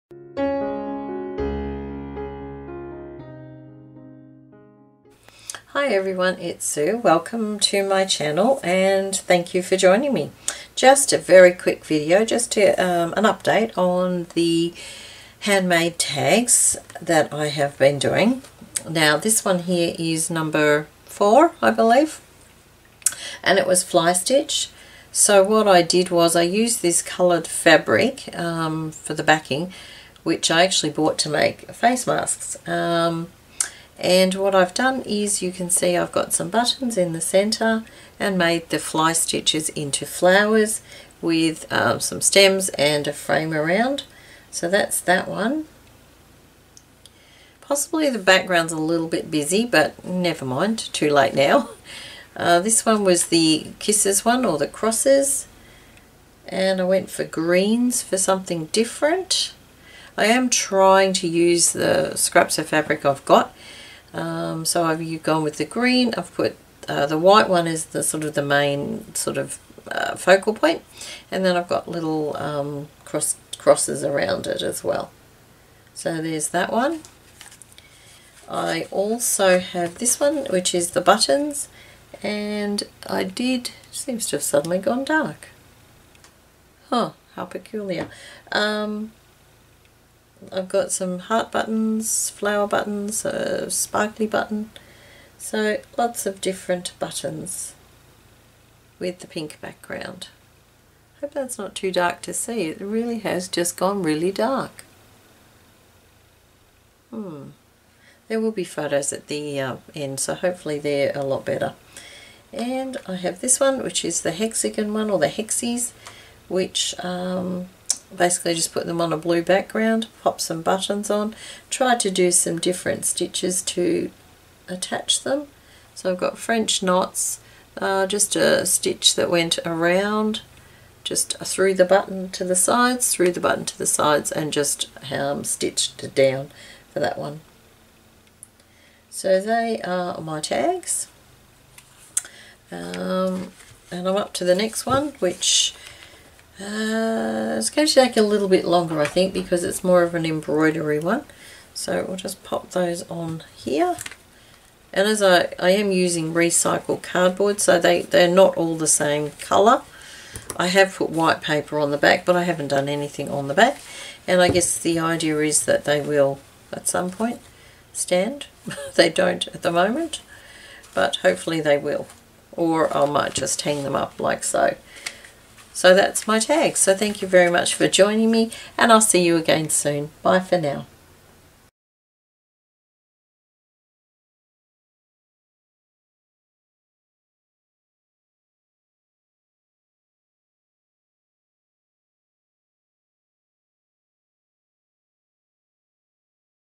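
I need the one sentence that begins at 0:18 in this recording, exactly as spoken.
Now this one here is number four, I believe, and it was fly stitch.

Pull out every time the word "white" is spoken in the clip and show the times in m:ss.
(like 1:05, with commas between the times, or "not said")
1:07, 2:41.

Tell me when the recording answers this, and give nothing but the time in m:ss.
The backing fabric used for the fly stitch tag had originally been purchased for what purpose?
0:31.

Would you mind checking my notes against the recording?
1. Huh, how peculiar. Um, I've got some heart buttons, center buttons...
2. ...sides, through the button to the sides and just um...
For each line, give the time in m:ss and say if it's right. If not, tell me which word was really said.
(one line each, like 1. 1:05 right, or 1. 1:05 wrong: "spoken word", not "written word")
1. 1:26 wrong: "flower", not "center"
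2. 2:12 right.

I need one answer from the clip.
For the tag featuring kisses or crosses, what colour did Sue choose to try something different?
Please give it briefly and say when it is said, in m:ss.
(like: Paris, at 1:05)
greens, at 0:57.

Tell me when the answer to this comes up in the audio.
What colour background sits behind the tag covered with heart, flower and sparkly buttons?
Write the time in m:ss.
1:39.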